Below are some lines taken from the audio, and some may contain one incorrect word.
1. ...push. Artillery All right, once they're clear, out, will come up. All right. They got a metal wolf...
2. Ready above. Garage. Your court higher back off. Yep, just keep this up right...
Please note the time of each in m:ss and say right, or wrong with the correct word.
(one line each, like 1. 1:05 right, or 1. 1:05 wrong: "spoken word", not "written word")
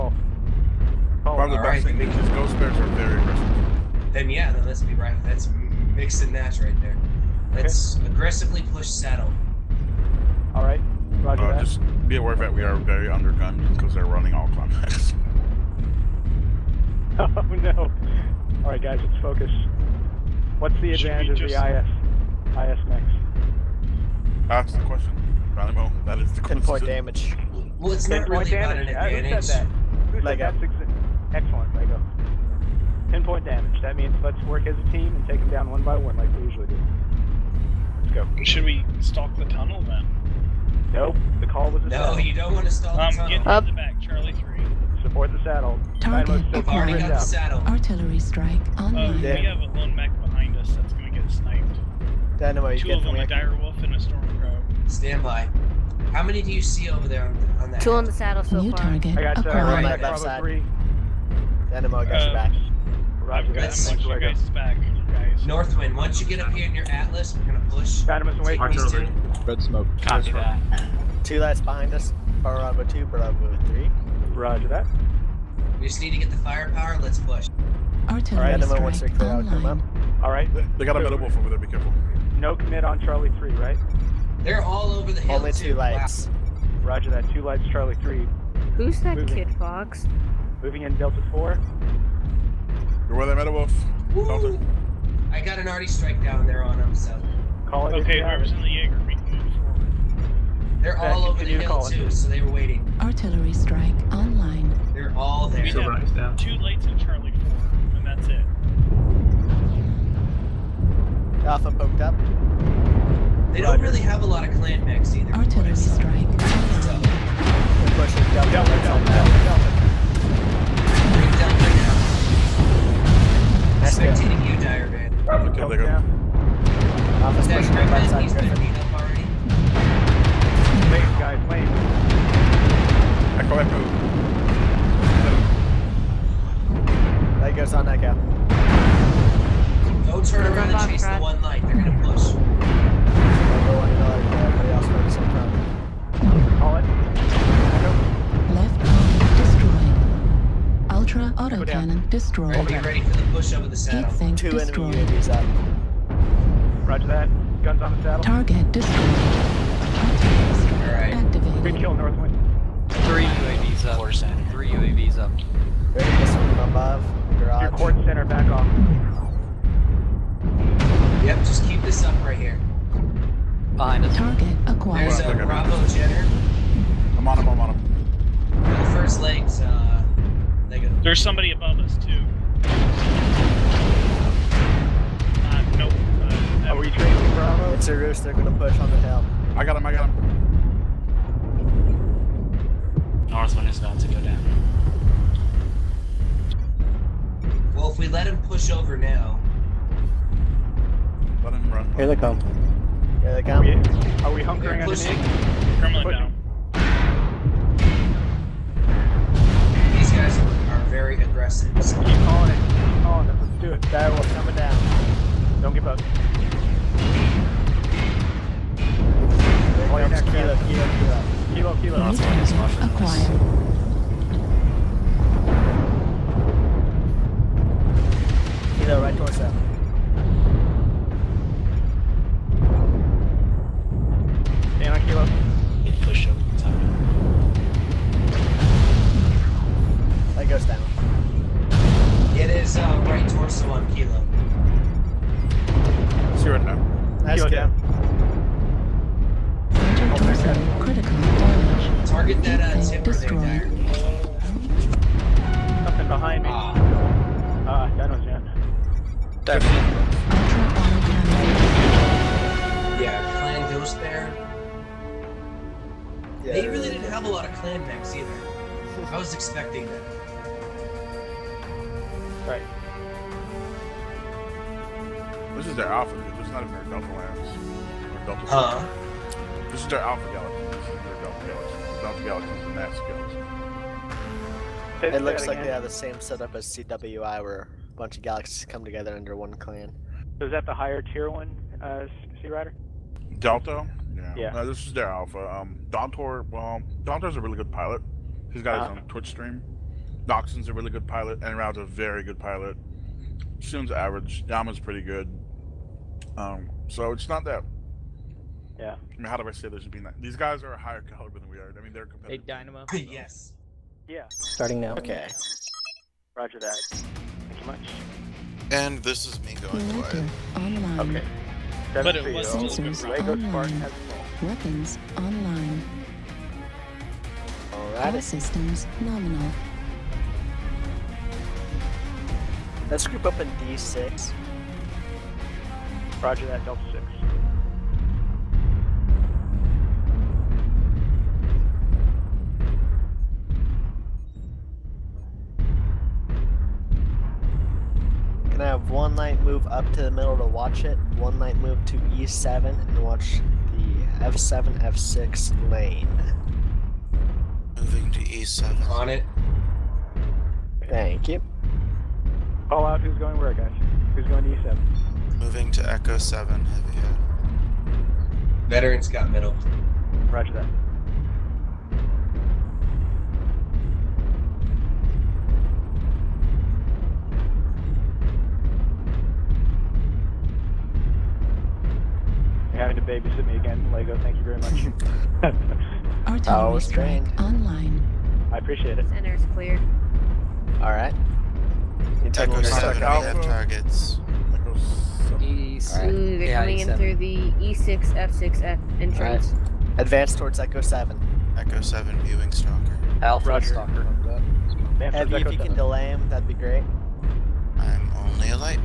1. 1:17 right
2. 2:45 wrong: "center", not "higher".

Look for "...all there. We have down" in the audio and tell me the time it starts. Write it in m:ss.
1:45.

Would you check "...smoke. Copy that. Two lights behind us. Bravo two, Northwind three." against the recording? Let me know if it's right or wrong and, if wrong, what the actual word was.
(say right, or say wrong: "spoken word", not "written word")
wrong: "Bravo", not "Northwind".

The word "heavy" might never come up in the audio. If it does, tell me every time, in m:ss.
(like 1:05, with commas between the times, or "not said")
6:06, 6:44.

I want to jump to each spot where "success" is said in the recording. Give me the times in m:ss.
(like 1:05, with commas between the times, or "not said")
not said.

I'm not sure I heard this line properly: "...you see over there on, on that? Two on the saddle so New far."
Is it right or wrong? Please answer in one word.
right.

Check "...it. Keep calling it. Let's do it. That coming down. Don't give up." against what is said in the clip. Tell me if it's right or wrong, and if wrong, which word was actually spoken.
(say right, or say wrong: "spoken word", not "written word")
right.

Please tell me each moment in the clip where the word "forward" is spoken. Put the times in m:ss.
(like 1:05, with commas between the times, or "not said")
1:39.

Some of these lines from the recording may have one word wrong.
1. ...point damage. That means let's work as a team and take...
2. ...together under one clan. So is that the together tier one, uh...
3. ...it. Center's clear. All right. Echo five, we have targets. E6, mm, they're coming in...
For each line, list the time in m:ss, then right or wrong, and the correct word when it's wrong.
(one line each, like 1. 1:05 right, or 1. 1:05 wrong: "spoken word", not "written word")
1. 0:33 right
2. 4:48 wrong: "higher", not "together"
3. 6:28 wrong: "seven", not "five".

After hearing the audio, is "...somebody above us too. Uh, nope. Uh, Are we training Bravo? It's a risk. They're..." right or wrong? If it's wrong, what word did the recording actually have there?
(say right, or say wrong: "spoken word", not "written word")
right.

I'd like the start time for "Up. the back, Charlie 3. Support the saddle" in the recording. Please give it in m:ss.
0:43.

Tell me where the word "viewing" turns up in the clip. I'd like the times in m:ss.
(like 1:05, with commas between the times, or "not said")
6:42.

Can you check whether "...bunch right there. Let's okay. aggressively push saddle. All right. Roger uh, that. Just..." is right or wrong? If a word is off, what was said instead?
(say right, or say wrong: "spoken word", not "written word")
wrong: "match", not "bunch".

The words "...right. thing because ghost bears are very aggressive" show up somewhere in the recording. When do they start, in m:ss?
0:01.